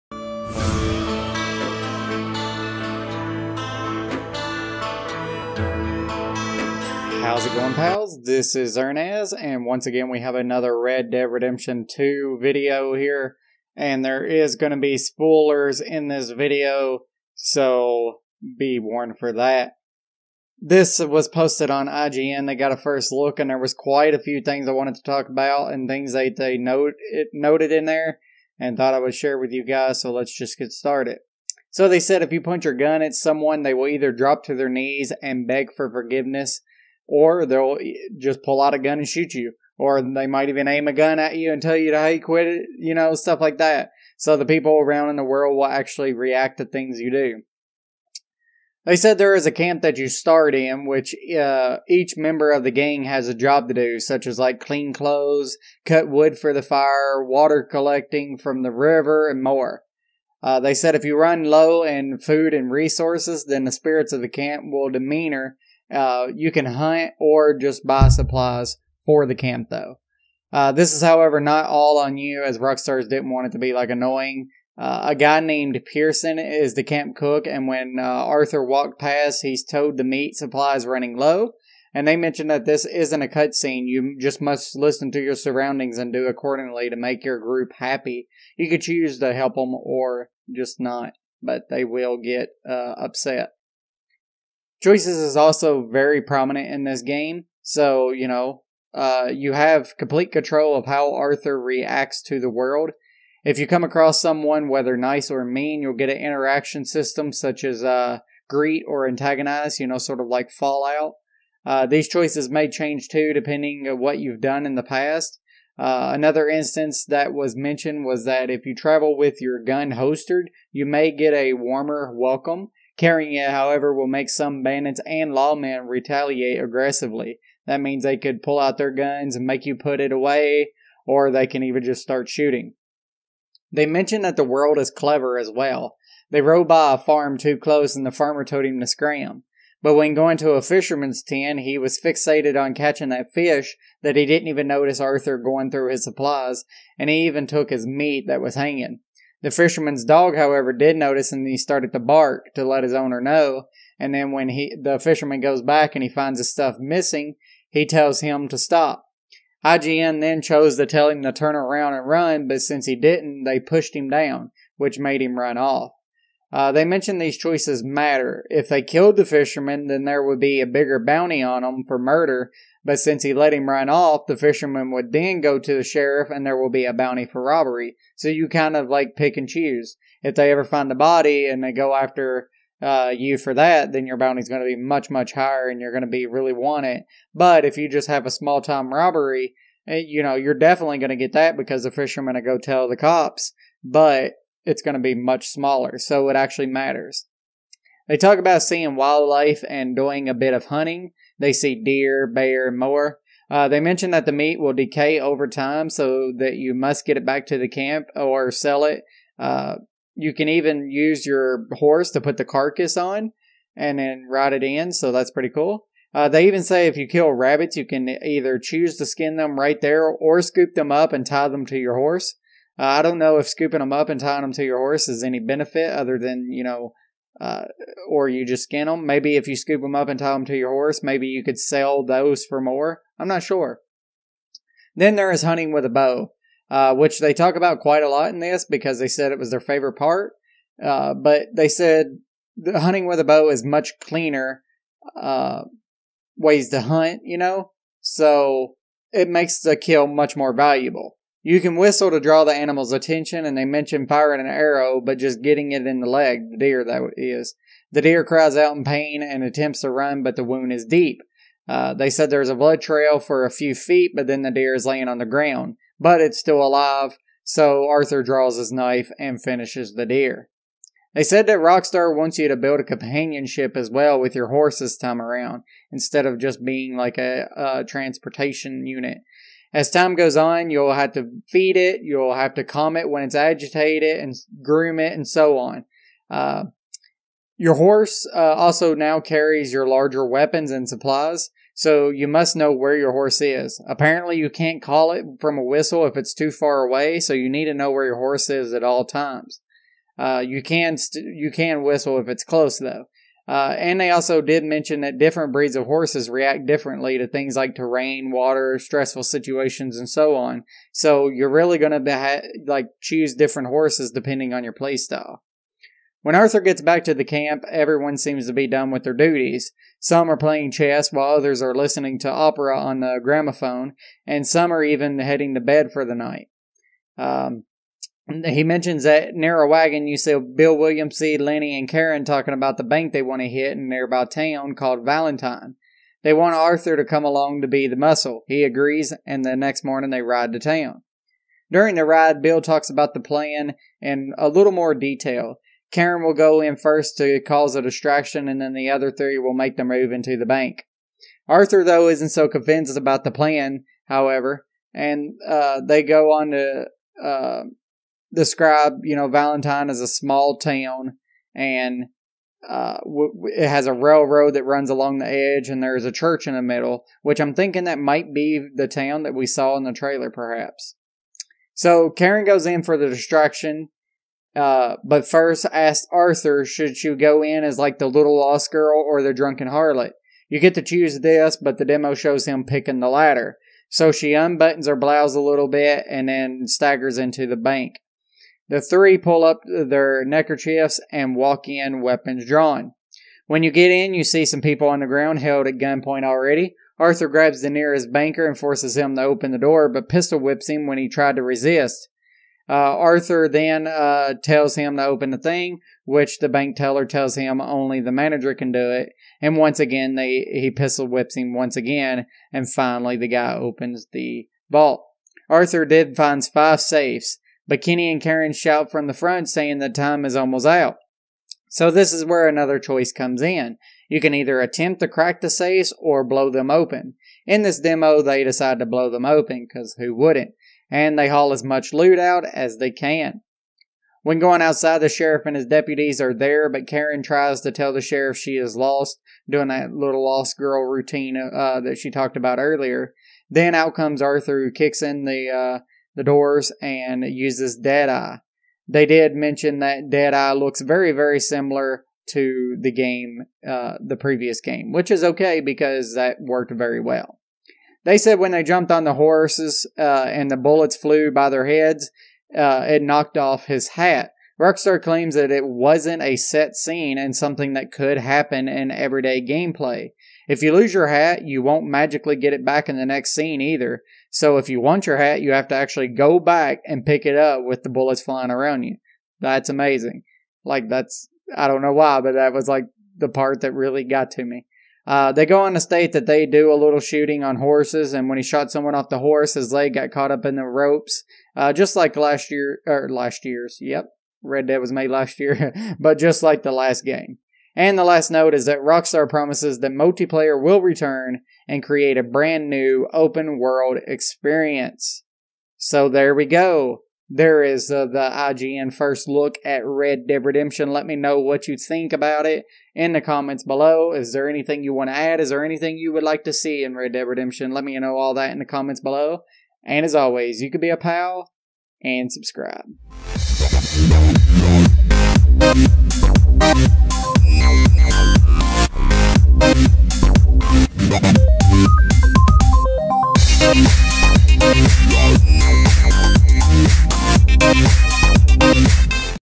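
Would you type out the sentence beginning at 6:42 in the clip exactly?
Uh, Arthur then uh, tells him to open the thing, which the bank teller tells him only the manager can do it.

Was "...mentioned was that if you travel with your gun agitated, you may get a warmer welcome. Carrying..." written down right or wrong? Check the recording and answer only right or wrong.
wrong.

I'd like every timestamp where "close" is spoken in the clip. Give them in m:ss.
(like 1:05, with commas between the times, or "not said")
2:17, 5:02.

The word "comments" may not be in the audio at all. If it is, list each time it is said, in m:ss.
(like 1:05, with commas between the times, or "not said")
8:33, 8:38.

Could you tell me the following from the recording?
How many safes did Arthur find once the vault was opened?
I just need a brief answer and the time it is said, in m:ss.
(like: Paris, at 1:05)
5, at 6:56.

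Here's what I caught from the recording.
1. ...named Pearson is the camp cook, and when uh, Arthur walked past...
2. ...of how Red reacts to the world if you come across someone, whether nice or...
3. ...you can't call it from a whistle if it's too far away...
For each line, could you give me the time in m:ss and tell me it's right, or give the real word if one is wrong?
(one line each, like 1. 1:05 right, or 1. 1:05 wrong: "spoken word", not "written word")
1. 1:15 right
2. 1:40 wrong: "Arthur", not "Red"
3. 4:54 right.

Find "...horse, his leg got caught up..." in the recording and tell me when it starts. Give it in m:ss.
8:09.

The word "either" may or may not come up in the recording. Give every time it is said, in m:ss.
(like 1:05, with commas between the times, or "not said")
0:33, 3:38, 7:04, 7:53.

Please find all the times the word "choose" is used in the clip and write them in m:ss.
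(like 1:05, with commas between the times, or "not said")
1:28, 2:59, 3:38, 5:13, 6:20.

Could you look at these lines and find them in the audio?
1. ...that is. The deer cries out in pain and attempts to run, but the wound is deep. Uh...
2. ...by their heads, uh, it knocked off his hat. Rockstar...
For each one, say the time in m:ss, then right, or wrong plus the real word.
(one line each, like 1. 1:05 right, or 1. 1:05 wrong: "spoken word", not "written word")
1. 4:16 right
2. 7:41 right.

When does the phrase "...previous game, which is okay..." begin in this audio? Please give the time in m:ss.
7:34.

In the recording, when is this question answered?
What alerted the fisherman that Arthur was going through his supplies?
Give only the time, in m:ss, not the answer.
2:30.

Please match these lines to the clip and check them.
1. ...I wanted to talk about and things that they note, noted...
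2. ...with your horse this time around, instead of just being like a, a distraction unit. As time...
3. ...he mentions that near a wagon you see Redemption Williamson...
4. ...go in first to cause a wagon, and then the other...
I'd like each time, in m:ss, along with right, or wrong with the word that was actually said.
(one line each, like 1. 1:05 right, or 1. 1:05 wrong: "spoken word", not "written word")
1. 0:24 right
2. 4:34 wrong: "transportation", not "distraction"
3. 5:28 wrong: "Bill", not "Redemption"
4. 5:46 wrong: "distraction", not "wagon".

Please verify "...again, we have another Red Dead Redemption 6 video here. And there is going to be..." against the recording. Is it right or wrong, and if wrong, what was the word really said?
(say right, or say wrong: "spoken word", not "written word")
wrong: "2", not "6".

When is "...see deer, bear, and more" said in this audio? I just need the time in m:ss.
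3:21.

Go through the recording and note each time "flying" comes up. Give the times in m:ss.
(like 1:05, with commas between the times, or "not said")
7:58.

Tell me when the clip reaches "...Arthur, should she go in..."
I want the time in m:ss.
6:16.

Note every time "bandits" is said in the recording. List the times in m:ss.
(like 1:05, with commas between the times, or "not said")
2:04.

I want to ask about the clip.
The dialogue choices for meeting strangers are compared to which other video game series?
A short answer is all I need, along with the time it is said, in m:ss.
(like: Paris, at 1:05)
Fallout, at 1:50.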